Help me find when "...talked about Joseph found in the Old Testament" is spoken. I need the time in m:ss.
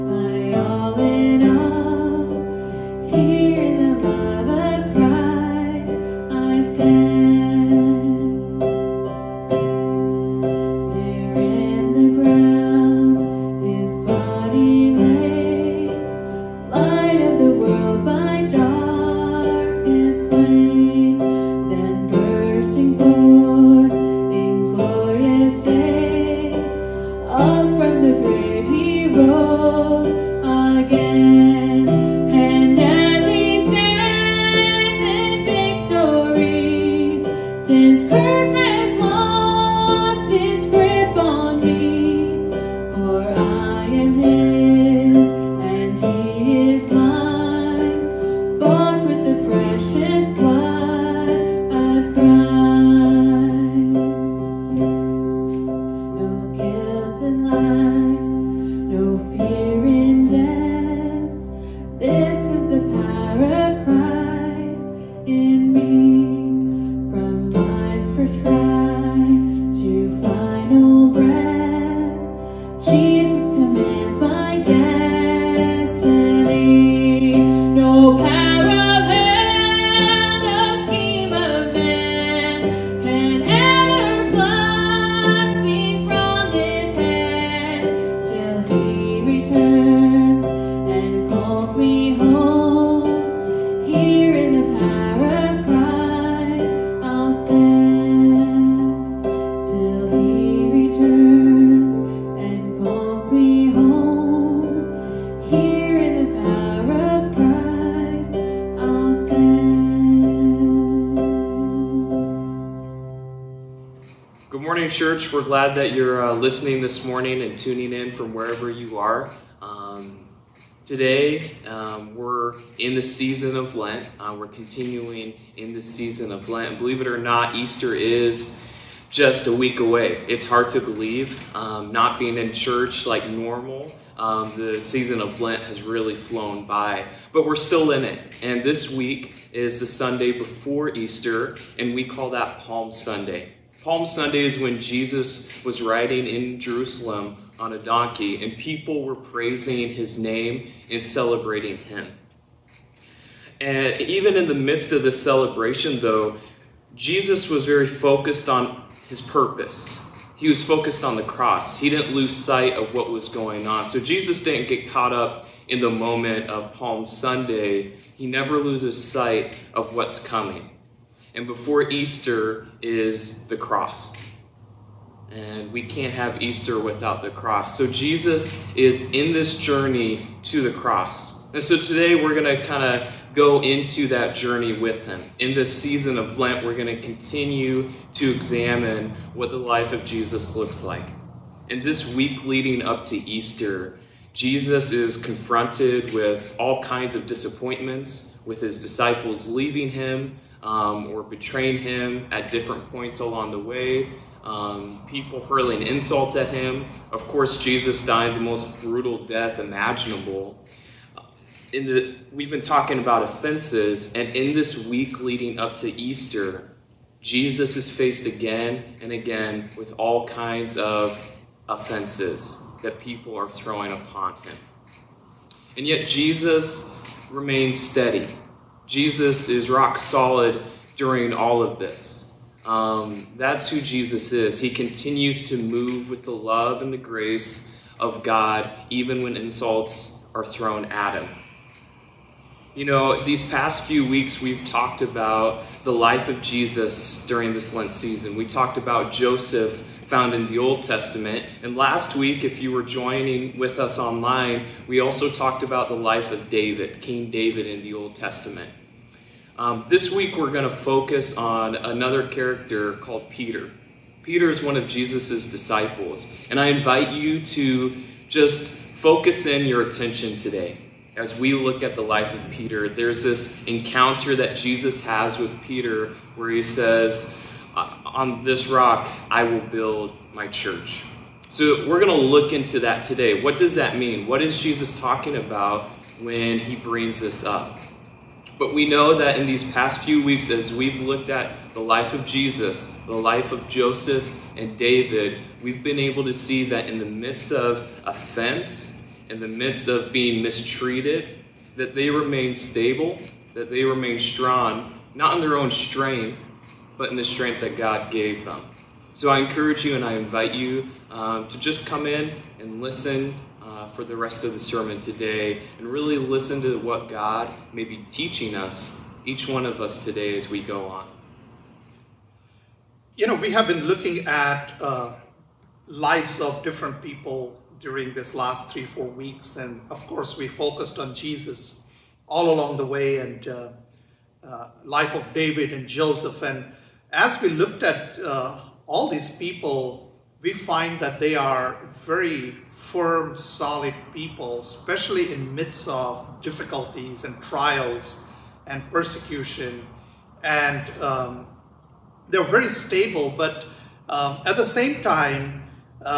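4:08.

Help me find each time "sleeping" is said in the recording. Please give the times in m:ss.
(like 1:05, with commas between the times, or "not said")
not said.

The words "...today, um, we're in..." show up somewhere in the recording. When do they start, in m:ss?
2:00.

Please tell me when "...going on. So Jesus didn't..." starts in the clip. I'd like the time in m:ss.
2:43.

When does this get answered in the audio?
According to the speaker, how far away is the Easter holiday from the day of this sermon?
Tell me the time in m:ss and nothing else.
2:09.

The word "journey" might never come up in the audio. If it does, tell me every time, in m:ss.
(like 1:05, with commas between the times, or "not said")
2:59, 3:04.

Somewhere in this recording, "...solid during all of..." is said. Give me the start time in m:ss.
3:49.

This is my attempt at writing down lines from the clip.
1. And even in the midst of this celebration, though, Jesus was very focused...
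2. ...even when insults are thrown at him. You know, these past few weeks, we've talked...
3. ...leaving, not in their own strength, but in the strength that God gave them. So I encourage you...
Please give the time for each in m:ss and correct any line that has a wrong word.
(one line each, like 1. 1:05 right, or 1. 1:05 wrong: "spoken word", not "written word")
1. 2:33 right
2. 3:58 right
3. 5:04 wrong: "strong", not "leaving".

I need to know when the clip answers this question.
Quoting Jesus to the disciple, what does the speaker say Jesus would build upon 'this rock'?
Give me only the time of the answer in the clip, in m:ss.
4:40.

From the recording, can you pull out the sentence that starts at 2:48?
He never loses sight of what's coming.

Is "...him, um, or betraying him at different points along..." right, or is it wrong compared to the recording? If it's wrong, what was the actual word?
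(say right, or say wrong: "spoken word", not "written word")
right.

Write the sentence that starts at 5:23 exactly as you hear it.
You know, we have been looking at uh, lives of different people during this last three, four weeks.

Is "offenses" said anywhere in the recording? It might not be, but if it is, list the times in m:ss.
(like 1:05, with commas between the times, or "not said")
3:33, 3:41, 4:58.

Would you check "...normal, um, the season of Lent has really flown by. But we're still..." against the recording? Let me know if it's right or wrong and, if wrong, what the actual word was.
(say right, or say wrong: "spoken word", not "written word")
right.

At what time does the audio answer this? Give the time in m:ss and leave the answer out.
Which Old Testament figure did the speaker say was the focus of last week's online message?
4:17.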